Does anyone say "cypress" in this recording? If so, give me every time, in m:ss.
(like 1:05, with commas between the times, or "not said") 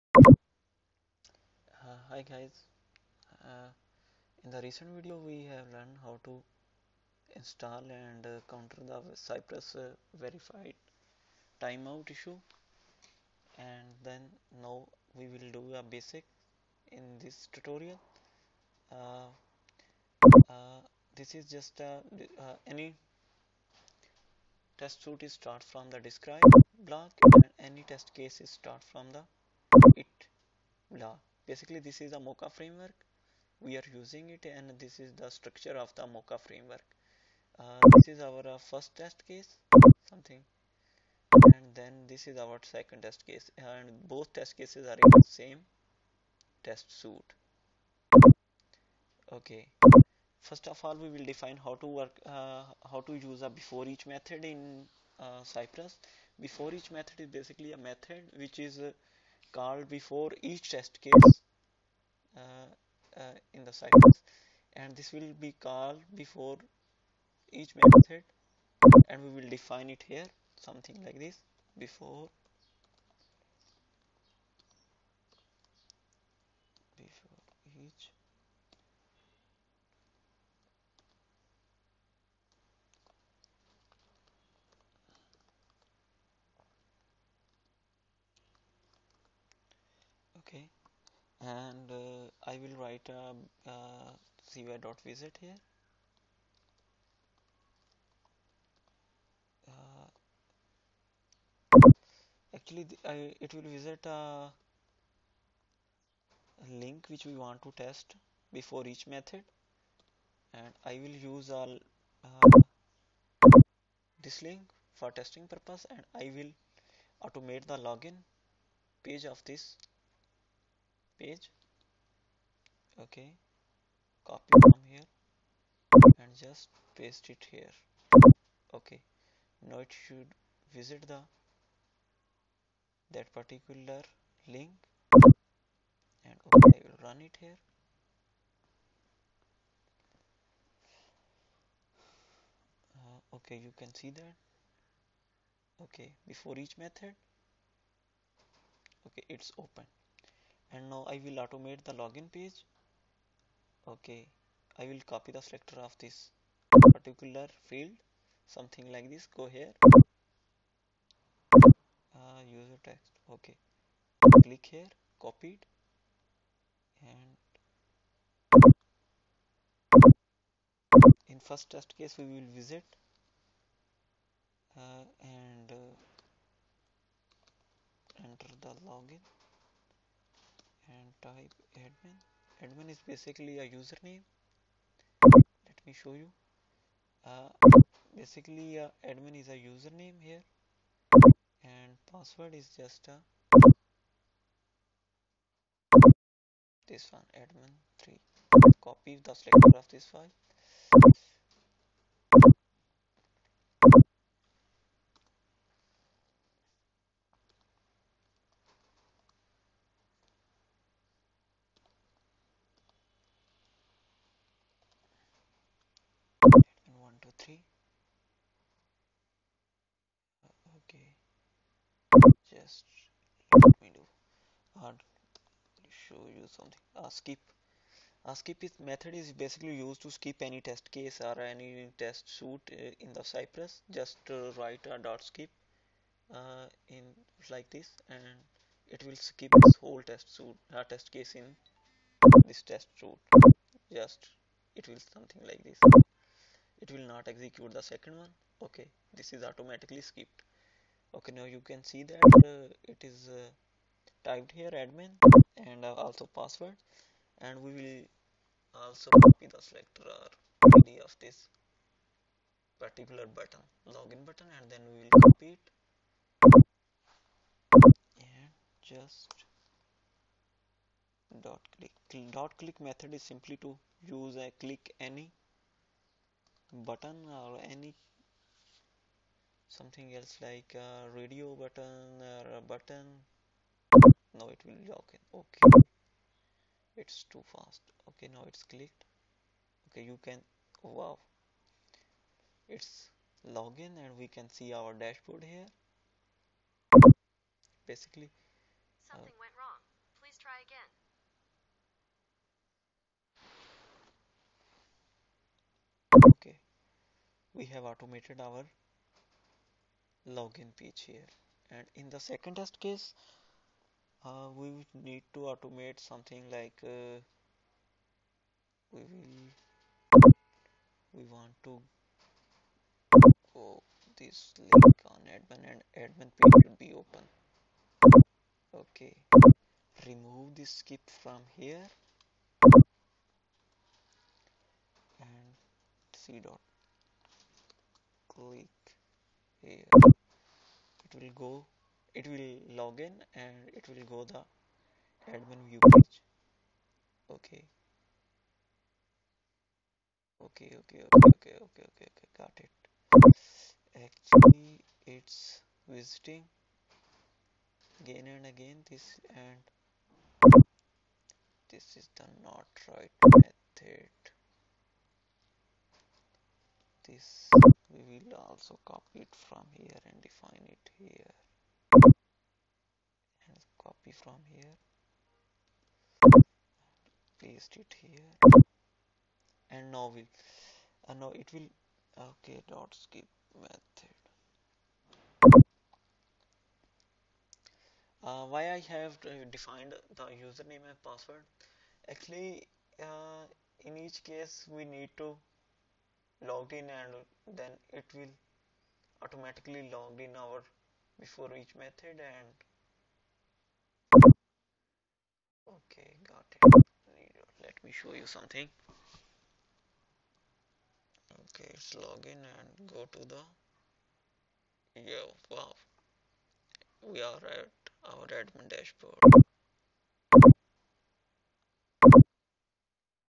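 0:09, 0:55, 1:03, 3:53.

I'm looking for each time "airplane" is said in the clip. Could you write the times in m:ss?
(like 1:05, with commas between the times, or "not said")
not said.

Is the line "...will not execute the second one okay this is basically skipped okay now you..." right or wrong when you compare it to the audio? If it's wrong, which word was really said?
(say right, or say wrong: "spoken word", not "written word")
wrong: "automatically", not "basically".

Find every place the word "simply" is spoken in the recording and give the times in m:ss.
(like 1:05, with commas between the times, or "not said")
4:33.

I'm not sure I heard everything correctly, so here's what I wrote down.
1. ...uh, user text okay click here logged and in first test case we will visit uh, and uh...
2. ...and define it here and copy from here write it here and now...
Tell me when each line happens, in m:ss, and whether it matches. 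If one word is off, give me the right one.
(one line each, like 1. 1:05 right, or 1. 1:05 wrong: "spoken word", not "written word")
1. 2:42 wrong: "copied", not "logged"
2. 6:10 wrong: "paste", not "write".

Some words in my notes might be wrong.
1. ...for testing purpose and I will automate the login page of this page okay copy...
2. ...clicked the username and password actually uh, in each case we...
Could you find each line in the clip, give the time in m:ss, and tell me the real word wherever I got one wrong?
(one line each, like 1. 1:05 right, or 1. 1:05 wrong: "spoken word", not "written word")
1. 1:54 right
2. 6:29 wrong: "defined", not "clicked".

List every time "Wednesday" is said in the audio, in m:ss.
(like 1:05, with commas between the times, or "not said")
not said.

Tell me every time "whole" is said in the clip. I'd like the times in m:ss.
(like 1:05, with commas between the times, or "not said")
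3:59.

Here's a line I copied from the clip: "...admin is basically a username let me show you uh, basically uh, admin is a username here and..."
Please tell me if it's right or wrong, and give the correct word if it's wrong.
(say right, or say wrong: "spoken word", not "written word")
right.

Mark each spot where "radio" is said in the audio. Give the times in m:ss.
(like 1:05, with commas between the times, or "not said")
4:41.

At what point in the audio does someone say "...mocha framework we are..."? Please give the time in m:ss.
0:32.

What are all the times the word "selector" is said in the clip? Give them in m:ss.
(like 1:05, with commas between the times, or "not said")
2:35, 3:19, 4:19.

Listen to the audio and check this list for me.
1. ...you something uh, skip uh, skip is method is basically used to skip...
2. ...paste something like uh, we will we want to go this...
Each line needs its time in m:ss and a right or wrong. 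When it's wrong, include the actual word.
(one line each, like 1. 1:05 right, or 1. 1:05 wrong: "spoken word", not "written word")
1. 3:46 right
2. 5:15 wrong: "automate", not "paste".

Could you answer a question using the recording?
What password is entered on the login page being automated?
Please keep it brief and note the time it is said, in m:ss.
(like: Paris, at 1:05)
admin3, at 3:17.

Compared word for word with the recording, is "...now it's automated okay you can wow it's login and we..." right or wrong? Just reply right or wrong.
wrong.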